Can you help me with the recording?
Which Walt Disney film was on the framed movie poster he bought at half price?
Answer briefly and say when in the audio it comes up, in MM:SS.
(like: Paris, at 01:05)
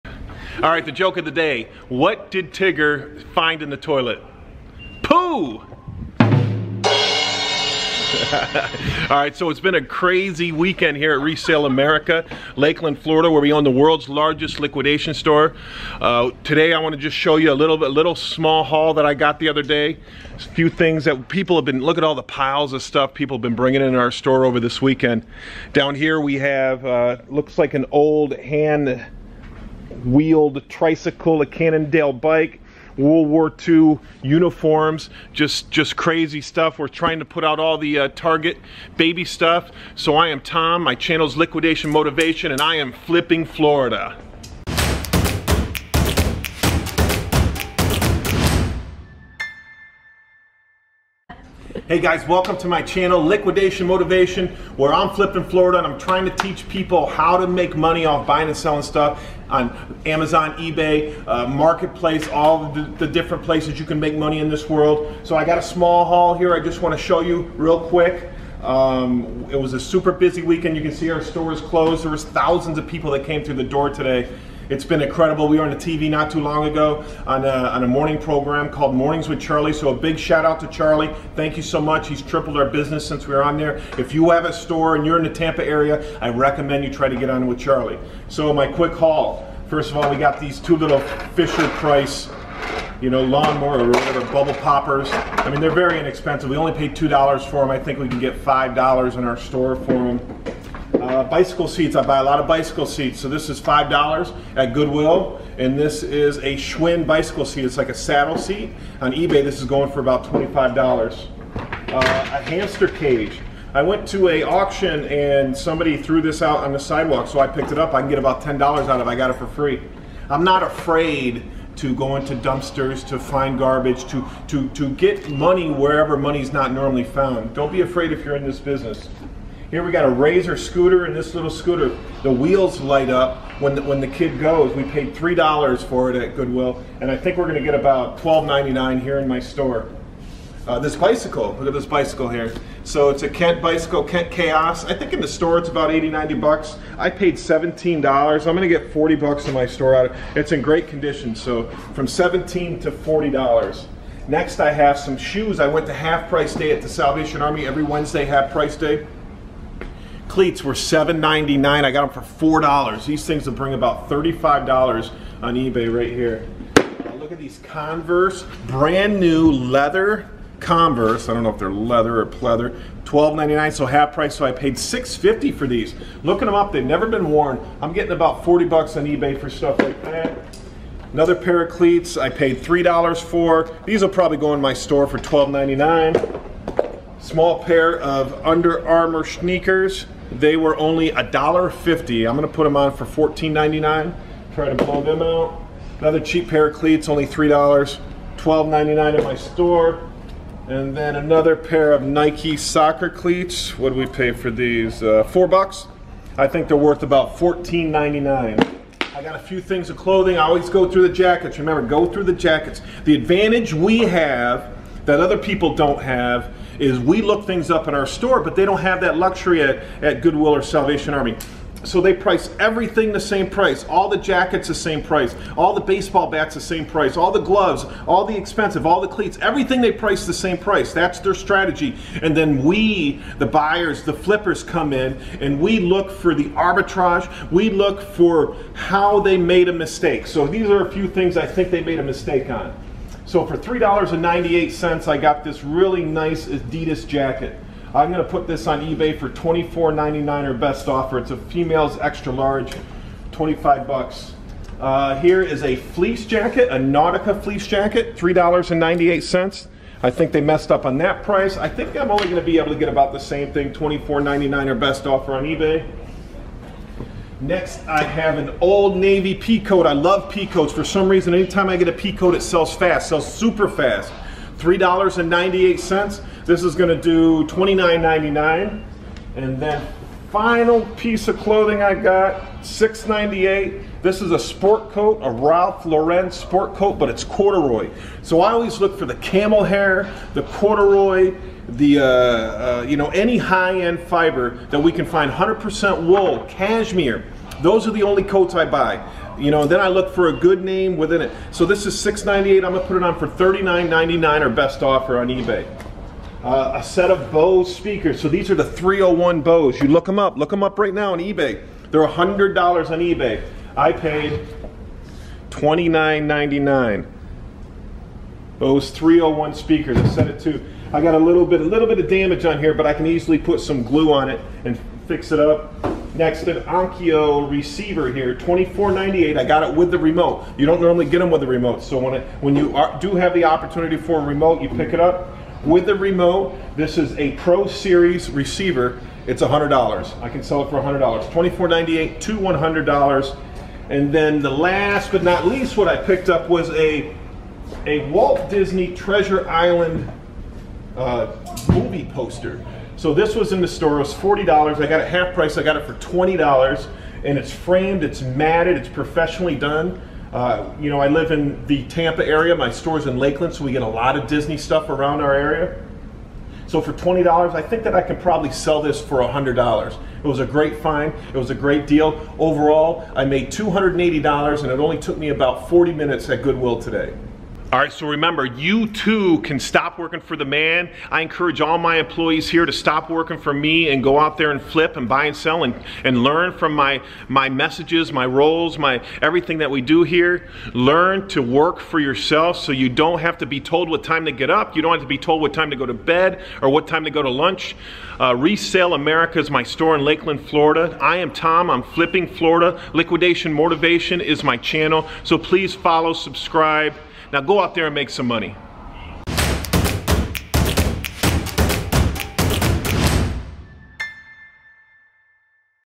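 Treasure Island, at 05:48.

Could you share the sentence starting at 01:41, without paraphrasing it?
I buy a lot of bicycle seats.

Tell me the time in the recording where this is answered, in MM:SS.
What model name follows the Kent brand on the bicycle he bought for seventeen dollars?
02:24.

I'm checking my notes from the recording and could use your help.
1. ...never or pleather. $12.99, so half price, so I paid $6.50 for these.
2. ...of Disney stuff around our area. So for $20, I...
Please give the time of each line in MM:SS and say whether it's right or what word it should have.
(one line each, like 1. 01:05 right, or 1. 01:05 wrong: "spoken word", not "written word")
1. 02:51 wrong: "leather", not "never"
2. 06:04 right.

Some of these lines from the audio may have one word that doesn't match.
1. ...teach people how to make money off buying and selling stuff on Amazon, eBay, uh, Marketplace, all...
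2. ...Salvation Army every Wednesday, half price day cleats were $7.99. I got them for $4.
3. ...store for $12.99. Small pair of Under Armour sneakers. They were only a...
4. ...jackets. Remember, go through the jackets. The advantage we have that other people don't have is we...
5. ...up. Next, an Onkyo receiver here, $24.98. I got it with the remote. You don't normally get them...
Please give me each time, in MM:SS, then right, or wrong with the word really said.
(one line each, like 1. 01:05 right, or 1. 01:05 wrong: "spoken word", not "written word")
1. 00:56 right
2. 02:36 right
3. 03:04 right
4. 03:31 right
5. 05:25 right.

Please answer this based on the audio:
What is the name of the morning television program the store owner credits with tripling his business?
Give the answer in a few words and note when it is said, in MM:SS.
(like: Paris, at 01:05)
Mornings with Charlie, at 01:18.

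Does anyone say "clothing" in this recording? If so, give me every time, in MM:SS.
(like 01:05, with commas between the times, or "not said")
03:29, 04:41.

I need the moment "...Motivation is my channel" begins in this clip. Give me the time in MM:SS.
06:43.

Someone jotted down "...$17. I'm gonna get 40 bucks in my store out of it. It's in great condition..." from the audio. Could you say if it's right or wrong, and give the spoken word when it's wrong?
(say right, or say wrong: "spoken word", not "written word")
right.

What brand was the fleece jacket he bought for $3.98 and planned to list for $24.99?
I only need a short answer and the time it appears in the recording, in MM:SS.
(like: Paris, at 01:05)
Nautica, at 04:16.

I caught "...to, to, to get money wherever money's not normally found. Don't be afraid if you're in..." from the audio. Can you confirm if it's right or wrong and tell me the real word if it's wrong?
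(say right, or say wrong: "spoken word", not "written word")
right.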